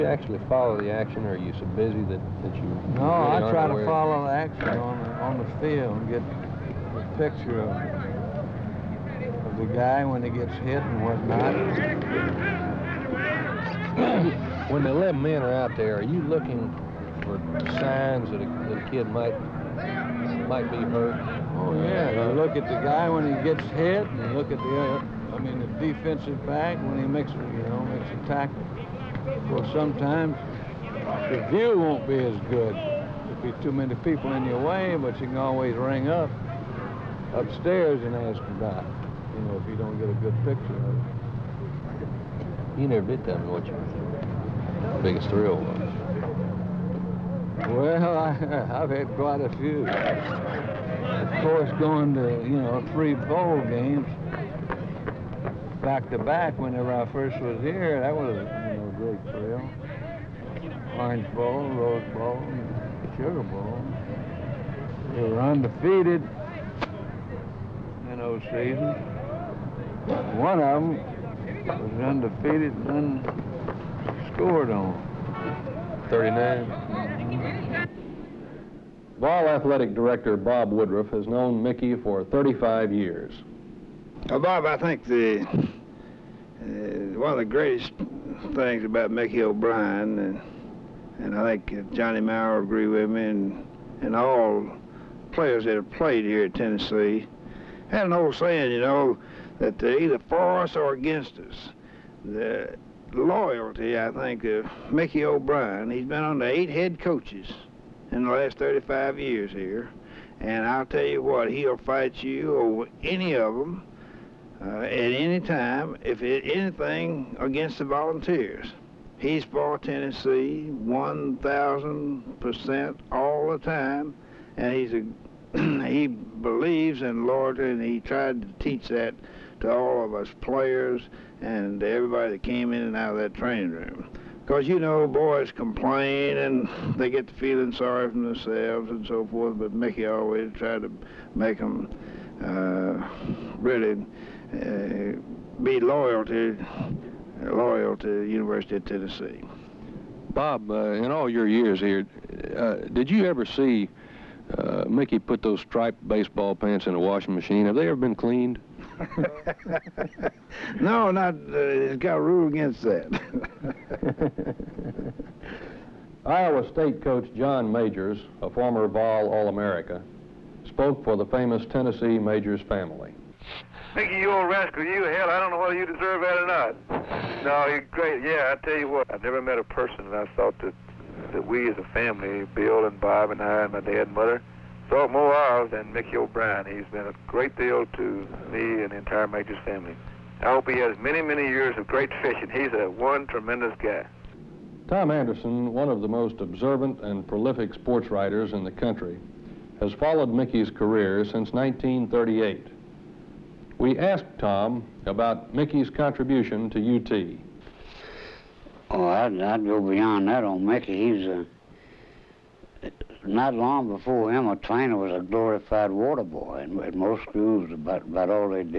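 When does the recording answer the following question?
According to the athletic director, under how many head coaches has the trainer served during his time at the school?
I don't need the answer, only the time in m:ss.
1:46.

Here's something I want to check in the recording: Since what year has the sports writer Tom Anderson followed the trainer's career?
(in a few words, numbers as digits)
1938.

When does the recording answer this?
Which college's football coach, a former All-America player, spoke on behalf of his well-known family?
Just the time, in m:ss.
2:46.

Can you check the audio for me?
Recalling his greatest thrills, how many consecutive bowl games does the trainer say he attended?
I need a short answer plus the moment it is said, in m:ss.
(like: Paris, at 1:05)
3, at 0:52.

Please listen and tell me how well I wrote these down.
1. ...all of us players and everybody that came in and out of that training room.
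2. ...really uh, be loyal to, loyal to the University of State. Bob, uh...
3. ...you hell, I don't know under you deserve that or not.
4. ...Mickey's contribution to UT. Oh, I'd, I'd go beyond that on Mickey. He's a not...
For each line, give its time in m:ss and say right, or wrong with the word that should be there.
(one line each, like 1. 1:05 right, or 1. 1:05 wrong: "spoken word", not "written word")
1. 2:09 right
2. 2:23 wrong: "Tennessee", not "State"
3. 2:54 wrong: "whether", not "under"
4. 3:25 right.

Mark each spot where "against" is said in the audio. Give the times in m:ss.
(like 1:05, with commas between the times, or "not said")
1:40, 1:57, 2:42.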